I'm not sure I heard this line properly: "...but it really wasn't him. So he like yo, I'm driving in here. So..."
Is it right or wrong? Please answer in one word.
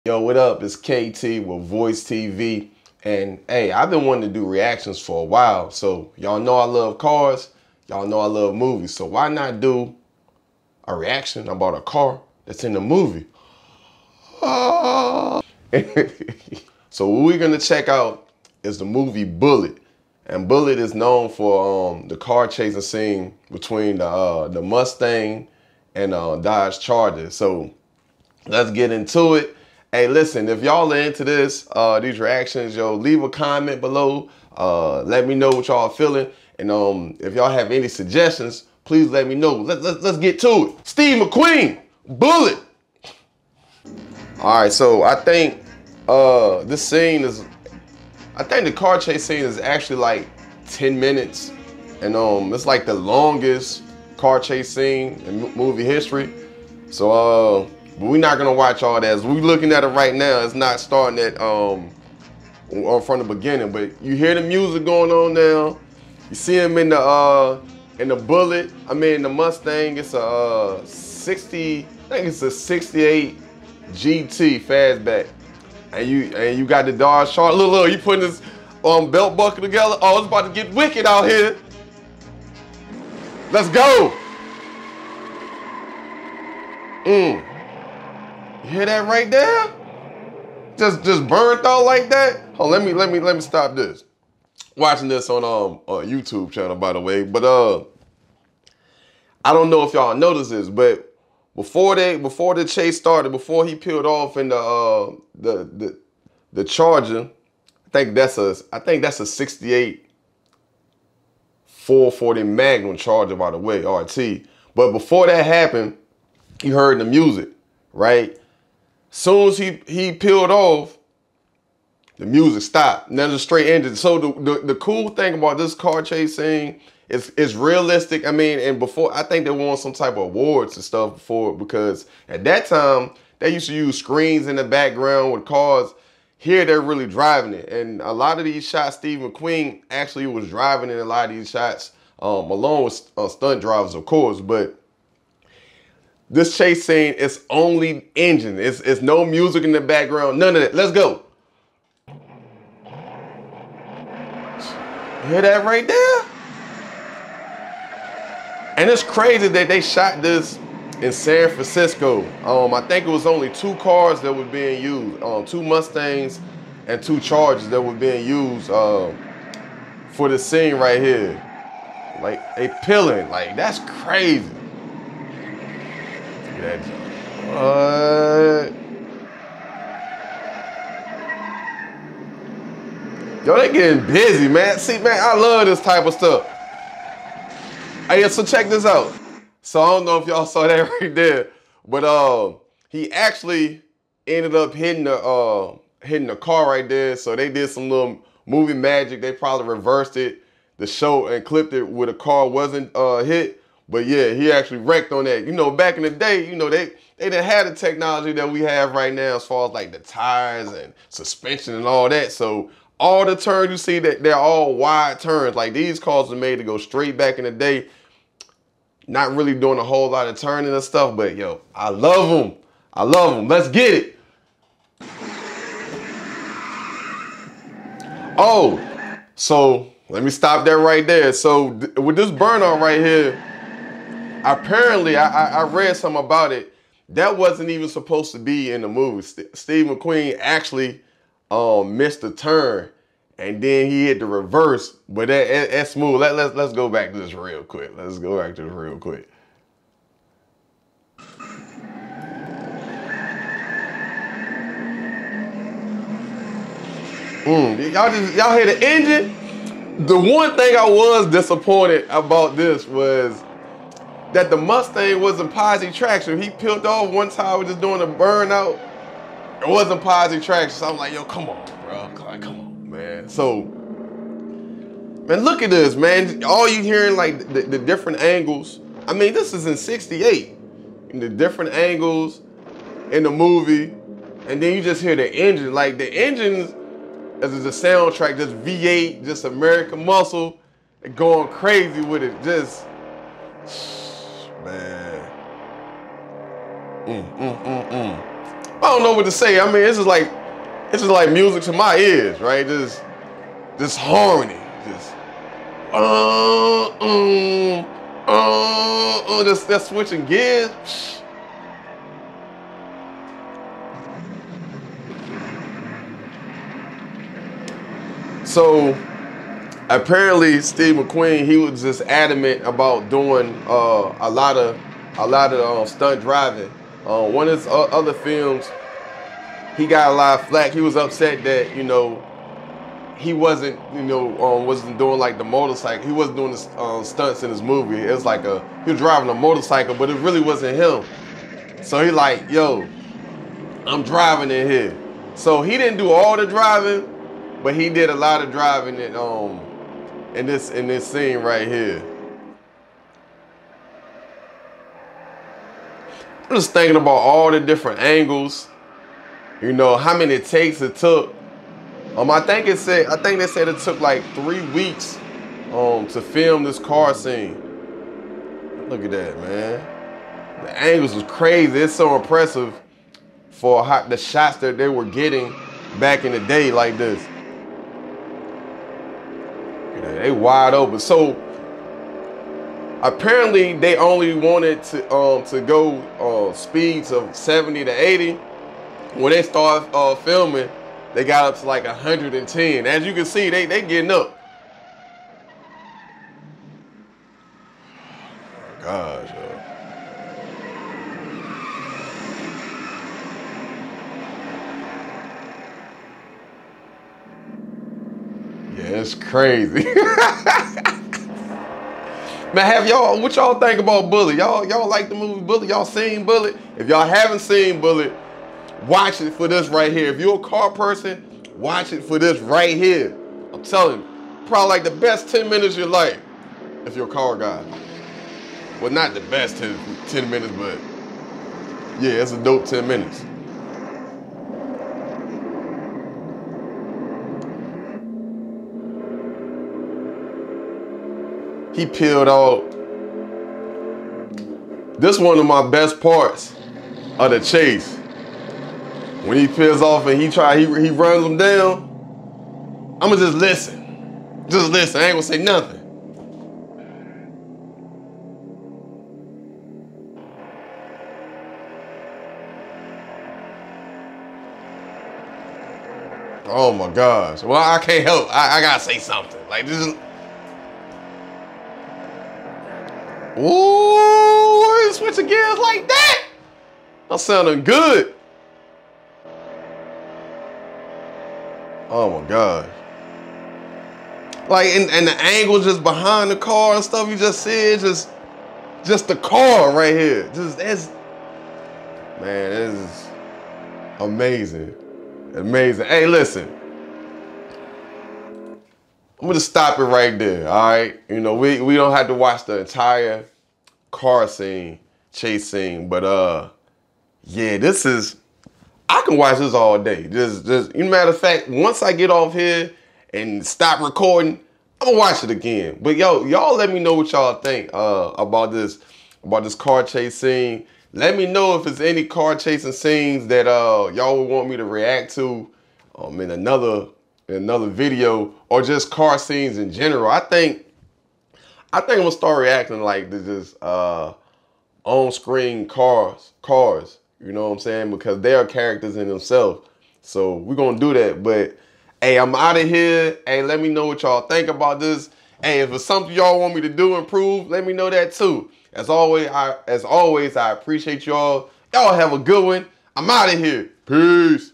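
right.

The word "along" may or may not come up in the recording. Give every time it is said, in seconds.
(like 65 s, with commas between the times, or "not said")
142 s.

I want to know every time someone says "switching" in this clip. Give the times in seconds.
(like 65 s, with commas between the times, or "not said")
309 s, 474 s.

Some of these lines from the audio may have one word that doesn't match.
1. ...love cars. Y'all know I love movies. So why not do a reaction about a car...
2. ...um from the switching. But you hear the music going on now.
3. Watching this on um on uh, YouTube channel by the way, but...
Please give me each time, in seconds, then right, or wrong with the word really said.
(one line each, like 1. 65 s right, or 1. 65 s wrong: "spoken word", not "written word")
1. 6 s right
2. 61 s wrong: "beginning", not "switching"
3. 94 s right.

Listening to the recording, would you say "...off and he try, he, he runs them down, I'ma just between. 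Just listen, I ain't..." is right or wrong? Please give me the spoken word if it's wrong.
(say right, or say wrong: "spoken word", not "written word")
wrong: "listen", not "between".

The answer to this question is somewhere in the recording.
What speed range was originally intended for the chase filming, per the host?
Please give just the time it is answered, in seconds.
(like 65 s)
387 s.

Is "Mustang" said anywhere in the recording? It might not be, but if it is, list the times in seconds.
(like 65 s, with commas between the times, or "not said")
24 s, 69 s, 165 s, 264 s.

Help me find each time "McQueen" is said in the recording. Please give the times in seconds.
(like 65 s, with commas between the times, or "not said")
41 s, 139 s, 239 s, 320 s.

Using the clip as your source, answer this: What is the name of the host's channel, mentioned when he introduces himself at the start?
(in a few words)
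VoicedTV.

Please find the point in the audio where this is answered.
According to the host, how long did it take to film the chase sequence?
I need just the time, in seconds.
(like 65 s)
364 s.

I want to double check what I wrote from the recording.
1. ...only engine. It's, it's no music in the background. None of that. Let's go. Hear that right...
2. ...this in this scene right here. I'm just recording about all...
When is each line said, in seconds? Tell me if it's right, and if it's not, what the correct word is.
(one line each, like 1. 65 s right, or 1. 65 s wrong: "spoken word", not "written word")
1. 147 s right
2. 350 s wrong: "thinking", not "recording".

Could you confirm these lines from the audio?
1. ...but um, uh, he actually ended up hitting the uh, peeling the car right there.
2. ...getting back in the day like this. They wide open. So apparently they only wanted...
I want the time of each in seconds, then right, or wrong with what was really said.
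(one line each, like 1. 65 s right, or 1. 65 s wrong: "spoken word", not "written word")
1. 191 s wrong: "hitting", not "peeling"
2. 375 s right.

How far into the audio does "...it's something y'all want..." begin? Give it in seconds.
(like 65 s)
545 s.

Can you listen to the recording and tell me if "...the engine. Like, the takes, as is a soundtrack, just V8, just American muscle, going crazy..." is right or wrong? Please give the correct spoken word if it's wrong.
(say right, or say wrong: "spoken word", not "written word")
wrong: "engines", not "takes".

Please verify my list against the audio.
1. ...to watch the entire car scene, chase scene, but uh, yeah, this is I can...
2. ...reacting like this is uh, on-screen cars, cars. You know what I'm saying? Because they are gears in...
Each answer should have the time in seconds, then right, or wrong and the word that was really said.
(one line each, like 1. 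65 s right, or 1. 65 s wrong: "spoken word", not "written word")
1. 502 s right
2. 532 s wrong: "characters", not "gears".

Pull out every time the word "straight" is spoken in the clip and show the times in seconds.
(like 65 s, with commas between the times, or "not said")
123 s, 216 s.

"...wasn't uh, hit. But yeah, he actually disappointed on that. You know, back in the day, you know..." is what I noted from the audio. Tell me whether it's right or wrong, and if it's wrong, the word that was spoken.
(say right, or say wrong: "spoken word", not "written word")
wrong: "wrecked", not "disappointed".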